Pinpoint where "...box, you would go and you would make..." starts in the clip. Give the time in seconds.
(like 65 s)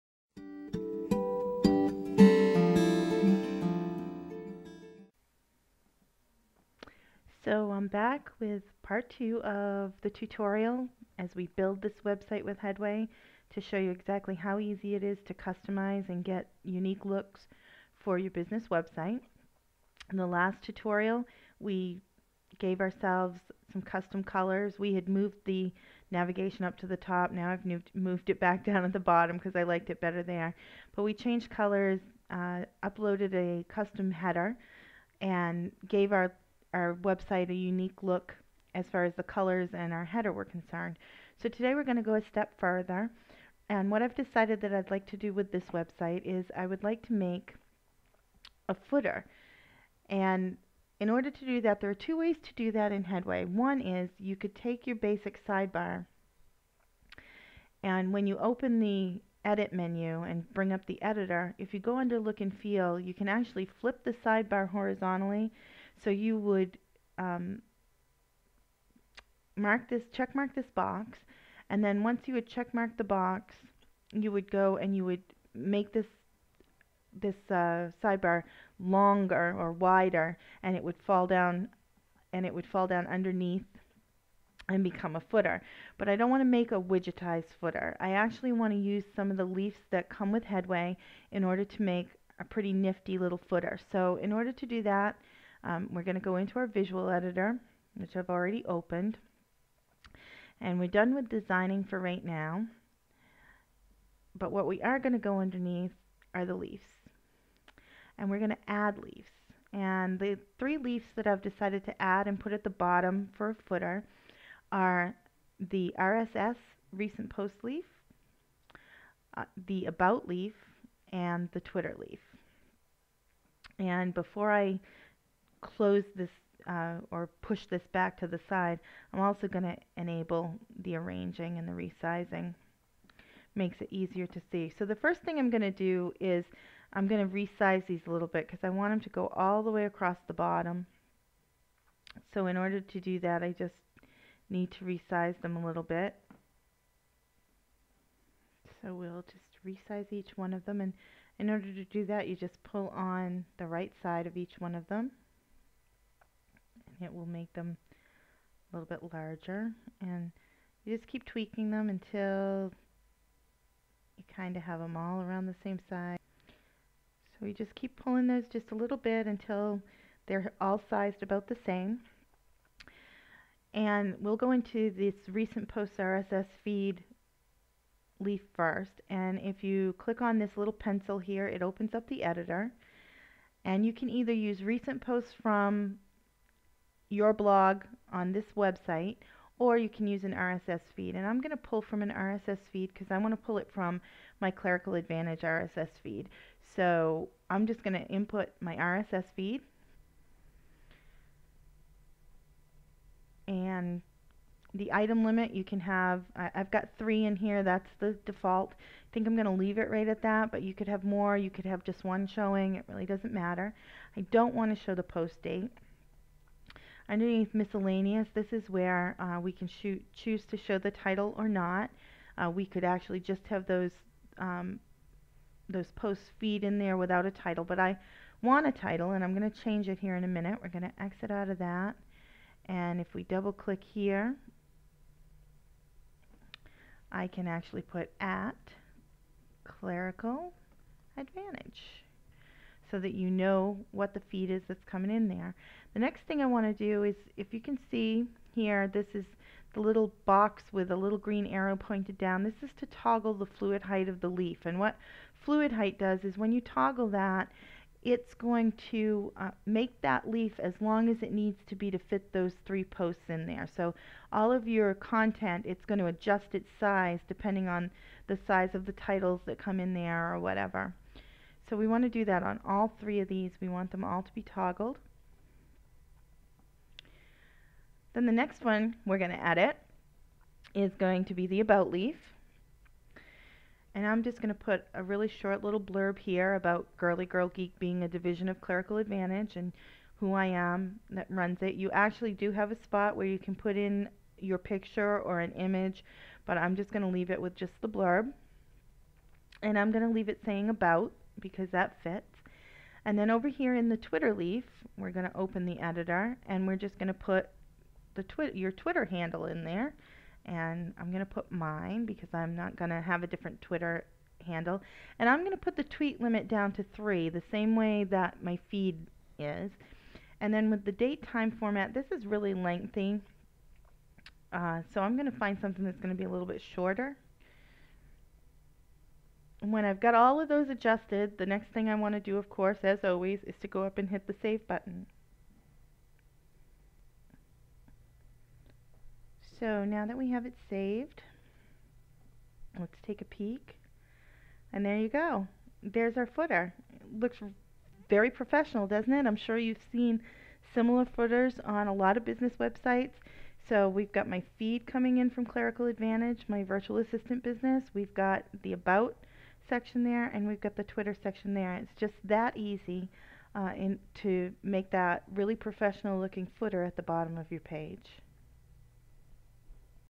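73 s.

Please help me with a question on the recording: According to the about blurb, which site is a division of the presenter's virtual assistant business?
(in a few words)
Girly Girl Geek.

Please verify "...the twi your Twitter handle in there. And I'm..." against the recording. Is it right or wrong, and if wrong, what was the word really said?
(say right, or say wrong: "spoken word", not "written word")
right.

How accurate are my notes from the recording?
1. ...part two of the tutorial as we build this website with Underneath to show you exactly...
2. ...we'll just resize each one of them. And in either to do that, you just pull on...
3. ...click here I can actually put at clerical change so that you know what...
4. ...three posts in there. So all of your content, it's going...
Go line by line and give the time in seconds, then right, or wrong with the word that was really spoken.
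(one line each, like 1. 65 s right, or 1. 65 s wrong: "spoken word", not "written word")
1. 8 s wrong: "Headway", not "Underneath"
2. 148 s wrong: "order", not "either"
3. 233 s wrong: "advantage", not "change"
4. 262 s right.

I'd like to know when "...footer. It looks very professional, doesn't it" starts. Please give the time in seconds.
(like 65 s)
346 s.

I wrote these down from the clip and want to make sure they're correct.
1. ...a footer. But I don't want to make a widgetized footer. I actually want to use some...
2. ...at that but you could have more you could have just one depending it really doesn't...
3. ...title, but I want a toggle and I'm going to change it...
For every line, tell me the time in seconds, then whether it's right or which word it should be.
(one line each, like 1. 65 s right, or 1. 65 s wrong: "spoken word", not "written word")
1. 85 s right
2. 210 s wrong: "showing", not "depending"
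3. 227 s wrong: "title", not "toggle".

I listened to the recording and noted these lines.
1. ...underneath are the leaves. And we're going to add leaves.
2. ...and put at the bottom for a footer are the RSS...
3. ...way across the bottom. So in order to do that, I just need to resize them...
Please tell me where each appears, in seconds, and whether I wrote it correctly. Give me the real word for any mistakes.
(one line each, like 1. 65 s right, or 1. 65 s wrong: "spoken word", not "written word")
1. 105 s right
2. 112 s right
3. 139 s right.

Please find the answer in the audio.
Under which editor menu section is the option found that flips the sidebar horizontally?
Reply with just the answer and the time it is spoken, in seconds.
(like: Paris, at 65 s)
look and feel, at 62 s.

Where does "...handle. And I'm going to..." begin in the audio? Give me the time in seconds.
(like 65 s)
314 s.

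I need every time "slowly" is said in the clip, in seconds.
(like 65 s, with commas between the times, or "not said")
not said.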